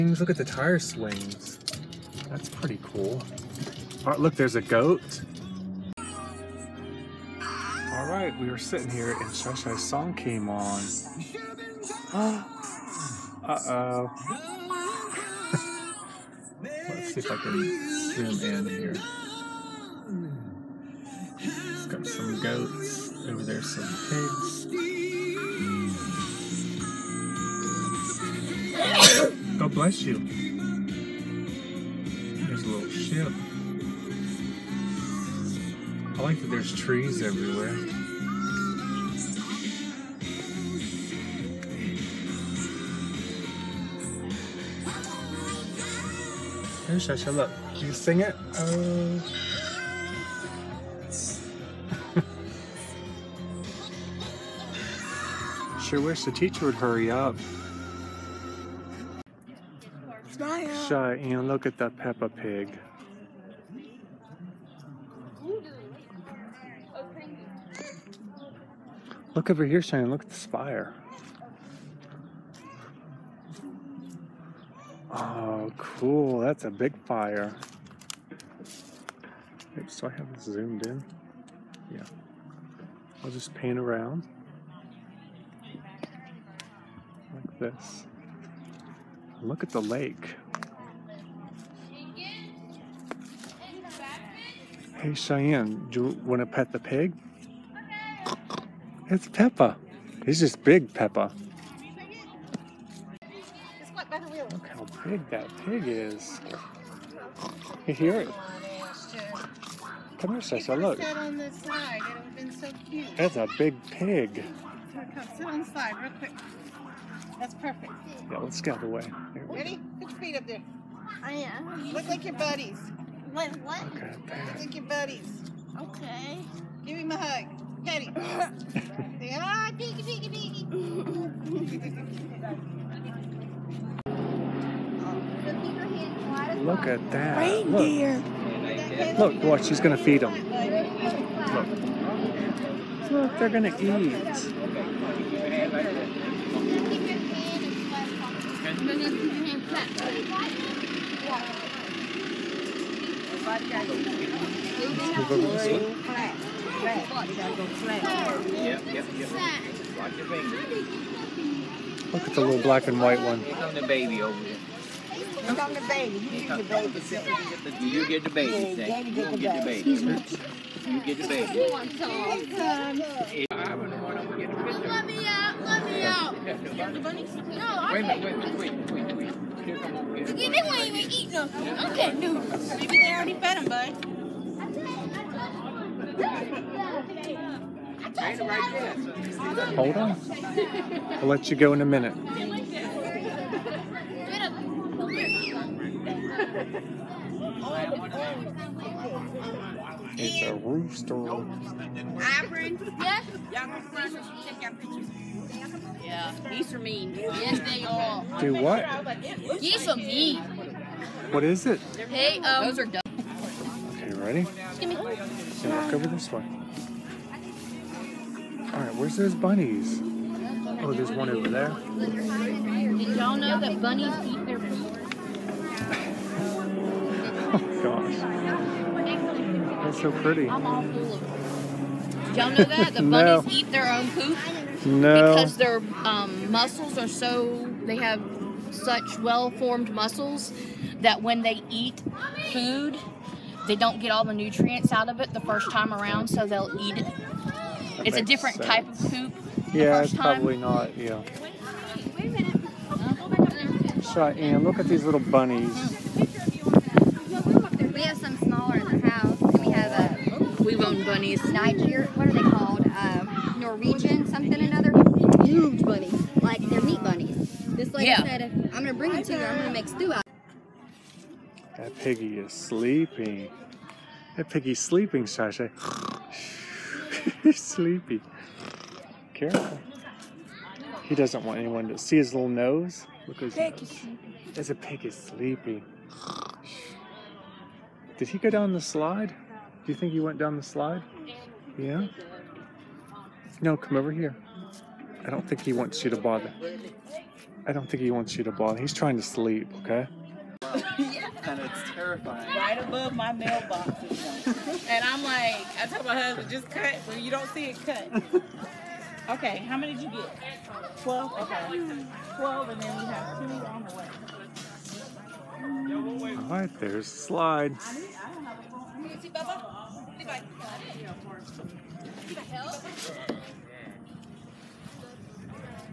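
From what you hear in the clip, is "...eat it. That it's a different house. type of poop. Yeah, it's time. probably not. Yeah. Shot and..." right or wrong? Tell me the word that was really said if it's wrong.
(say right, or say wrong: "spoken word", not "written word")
wrong: "sense", not "house".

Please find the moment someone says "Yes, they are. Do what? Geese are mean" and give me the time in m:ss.
3:27.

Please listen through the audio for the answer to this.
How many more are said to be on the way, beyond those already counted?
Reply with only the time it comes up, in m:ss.
5:13.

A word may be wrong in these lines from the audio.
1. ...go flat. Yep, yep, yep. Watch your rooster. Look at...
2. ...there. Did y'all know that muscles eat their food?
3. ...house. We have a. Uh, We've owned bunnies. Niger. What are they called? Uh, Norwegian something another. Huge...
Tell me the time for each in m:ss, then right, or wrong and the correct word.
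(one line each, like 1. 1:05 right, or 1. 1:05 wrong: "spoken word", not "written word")
1. 2:37 wrong: "finger", not "rooster"
2. 3:41 wrong: "bunnies", not "muscles"
3. 4:19 right.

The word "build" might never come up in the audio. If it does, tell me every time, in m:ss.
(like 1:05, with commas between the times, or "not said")
not said.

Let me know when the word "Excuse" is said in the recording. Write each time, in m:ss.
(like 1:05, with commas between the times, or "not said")
2:49.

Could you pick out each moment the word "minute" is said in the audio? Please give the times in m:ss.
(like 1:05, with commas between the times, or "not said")
2:58, 3:11.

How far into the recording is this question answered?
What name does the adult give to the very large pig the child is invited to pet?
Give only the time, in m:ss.
1:40.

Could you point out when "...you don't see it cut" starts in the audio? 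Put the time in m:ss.
5:07.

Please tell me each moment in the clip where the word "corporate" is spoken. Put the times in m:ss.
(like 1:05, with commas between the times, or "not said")
not said.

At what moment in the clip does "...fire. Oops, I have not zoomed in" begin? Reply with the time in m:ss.
1:17.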